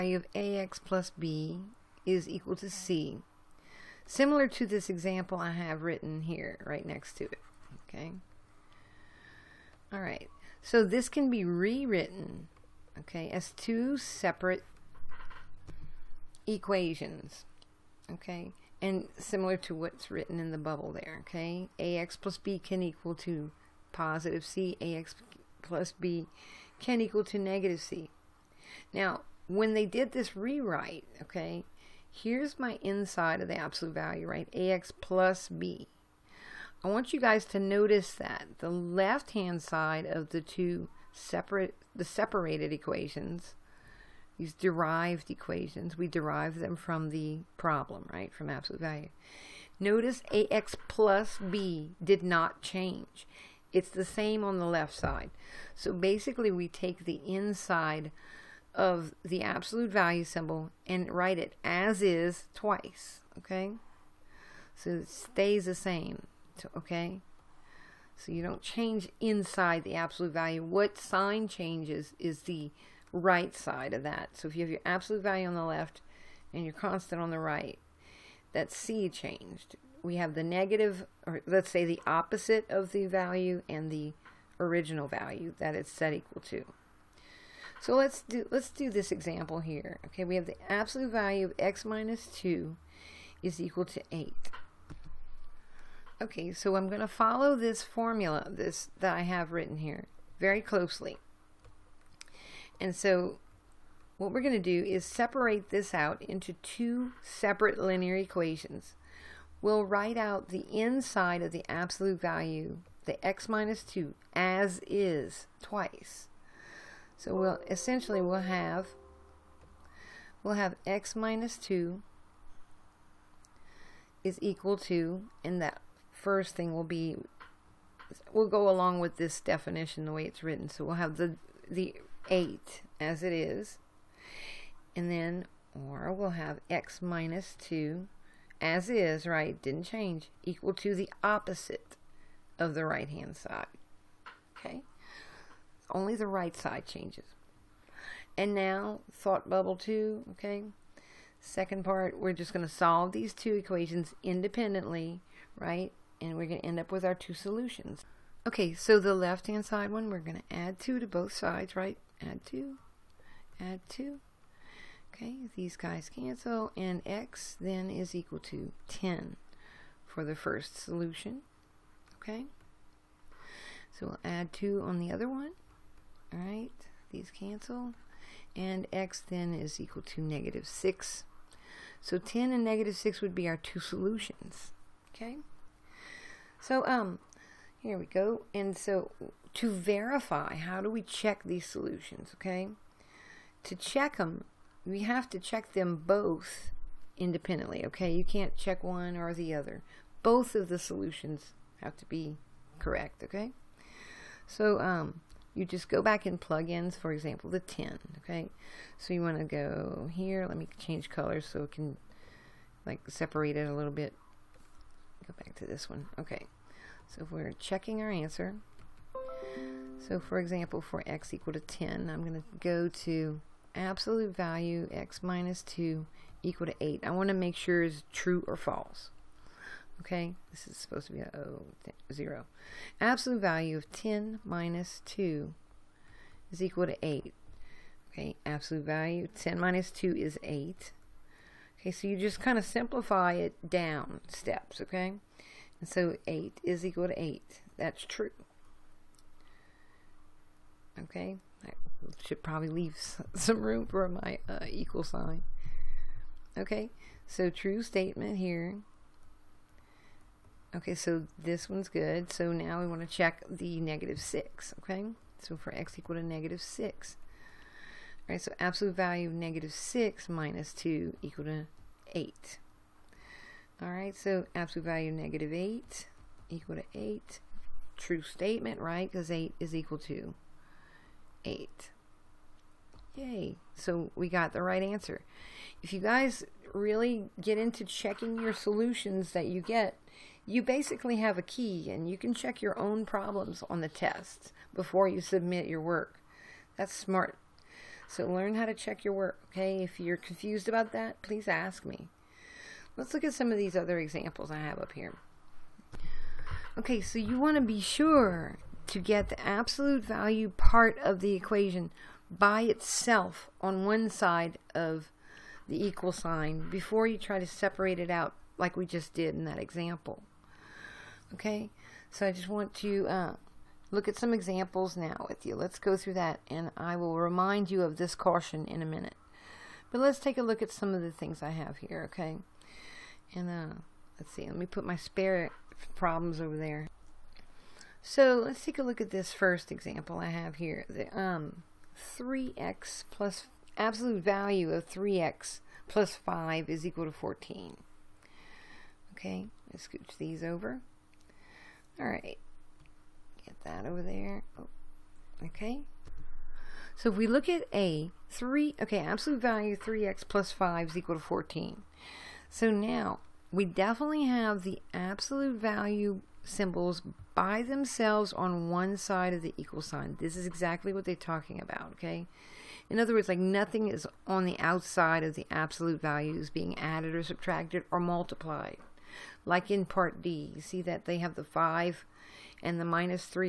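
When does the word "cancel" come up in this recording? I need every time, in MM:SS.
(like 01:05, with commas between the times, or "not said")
02:46, 02:57.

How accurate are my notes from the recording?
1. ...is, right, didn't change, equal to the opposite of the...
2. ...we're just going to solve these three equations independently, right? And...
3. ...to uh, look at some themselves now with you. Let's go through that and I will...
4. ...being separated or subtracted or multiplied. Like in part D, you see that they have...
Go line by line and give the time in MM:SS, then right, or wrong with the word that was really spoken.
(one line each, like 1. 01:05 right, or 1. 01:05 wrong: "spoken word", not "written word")
1. 02:18 right
2. 02:32 wrong: "two", not "three"
3. 05:22 wrong: "examples", not "themselves"
4. 06:16 wrong: "added", not "separated".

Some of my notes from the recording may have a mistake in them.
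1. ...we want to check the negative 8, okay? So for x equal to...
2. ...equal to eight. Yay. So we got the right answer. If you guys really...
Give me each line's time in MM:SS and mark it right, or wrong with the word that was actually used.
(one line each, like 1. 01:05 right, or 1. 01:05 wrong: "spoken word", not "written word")
1. 04:22 wrong: "6", not "8"
2. 04:39 right.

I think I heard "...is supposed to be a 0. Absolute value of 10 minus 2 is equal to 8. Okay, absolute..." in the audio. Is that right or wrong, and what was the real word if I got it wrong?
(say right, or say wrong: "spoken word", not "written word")
right.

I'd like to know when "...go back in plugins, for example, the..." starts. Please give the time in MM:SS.
03:25.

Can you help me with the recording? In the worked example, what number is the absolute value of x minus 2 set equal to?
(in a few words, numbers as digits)
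8.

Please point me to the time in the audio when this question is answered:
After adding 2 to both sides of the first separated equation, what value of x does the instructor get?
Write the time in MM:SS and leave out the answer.
02:47.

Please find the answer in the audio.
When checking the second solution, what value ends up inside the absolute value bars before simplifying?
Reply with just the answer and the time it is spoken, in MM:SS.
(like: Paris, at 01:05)
-8, at 04:34.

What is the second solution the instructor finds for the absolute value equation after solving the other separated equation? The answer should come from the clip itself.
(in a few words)
-6.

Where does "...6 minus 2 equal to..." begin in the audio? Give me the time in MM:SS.
04:29.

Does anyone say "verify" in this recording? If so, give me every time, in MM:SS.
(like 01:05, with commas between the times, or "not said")
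03:09.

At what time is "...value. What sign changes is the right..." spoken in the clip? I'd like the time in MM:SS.
01:10.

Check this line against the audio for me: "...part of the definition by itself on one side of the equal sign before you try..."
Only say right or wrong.
wrong.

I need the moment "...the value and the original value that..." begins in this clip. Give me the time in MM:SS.
01:22.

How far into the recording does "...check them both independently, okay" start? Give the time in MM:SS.
03:15.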